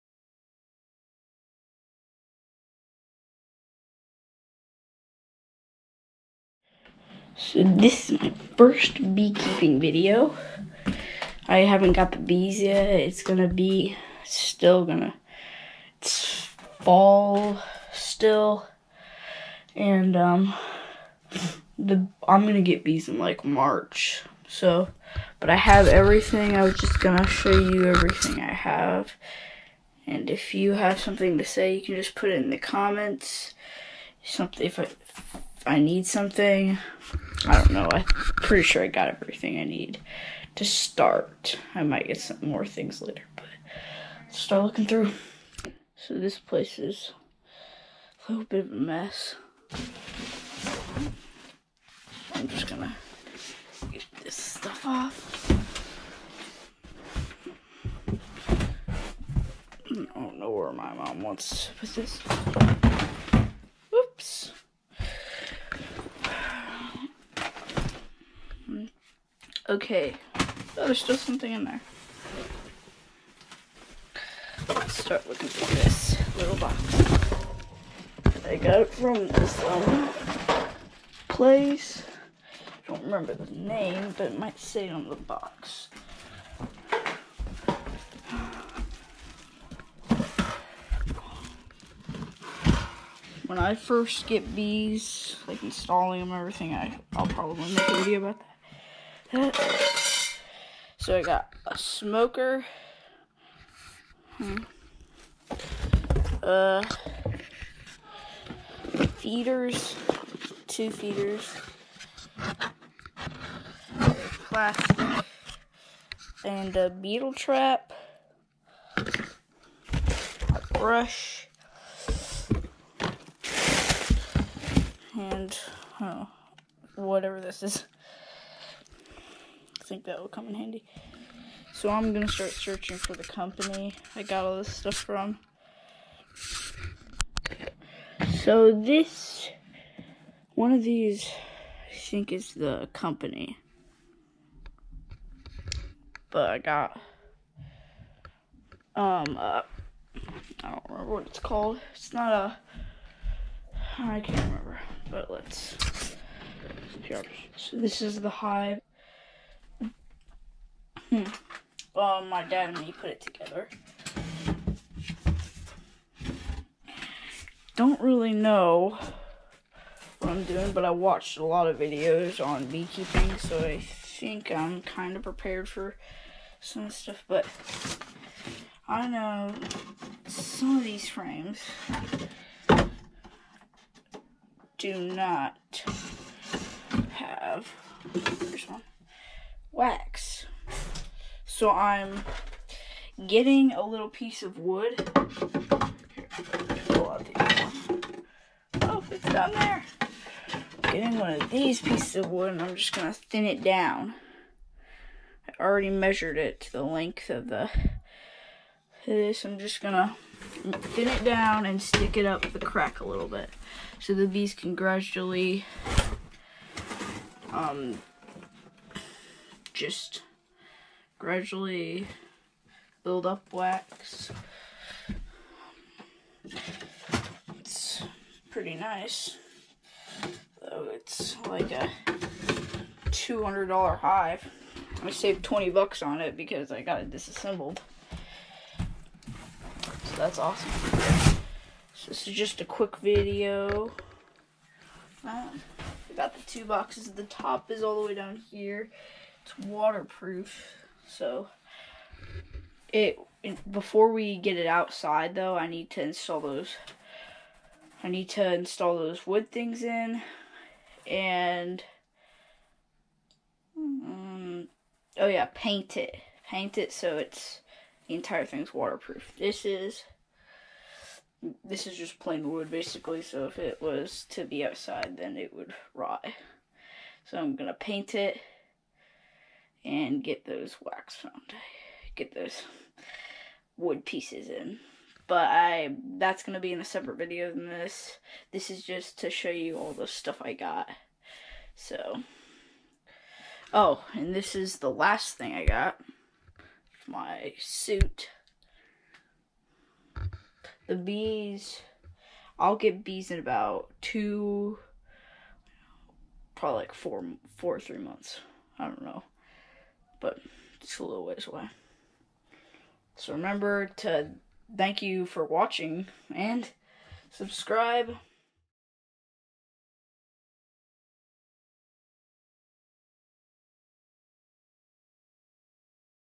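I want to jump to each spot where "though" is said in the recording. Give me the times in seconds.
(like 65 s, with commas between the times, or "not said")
230 s, 255 s.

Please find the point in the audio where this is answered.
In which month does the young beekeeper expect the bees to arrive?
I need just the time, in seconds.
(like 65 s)
23 s.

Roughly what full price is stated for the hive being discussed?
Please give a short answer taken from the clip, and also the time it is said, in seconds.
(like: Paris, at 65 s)
$200, at 233 s.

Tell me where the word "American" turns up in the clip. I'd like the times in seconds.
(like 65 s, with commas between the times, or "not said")
not said.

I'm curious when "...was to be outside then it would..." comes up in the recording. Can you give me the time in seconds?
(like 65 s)
273 s.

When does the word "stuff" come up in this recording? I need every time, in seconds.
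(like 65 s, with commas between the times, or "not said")
54 s, 134 s, 176 s, 290 s.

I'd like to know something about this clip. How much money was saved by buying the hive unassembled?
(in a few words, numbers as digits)
$20.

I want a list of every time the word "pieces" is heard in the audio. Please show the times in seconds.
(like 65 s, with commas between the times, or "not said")
194 s, 201 s, 284 s.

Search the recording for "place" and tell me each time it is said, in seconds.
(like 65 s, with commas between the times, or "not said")
46 s, 81 s.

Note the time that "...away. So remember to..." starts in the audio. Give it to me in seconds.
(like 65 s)
311 s.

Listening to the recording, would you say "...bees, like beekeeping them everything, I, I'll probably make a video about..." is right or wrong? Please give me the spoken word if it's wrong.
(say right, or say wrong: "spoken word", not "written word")
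wrong: "installing", not "beekeeping".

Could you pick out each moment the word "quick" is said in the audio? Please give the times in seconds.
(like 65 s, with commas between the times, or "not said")
242 s.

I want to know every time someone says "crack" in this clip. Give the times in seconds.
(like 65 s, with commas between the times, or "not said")
212 s.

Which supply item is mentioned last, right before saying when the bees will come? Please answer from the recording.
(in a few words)
Suit.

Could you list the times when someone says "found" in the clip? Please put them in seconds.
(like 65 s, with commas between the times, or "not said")
281 s.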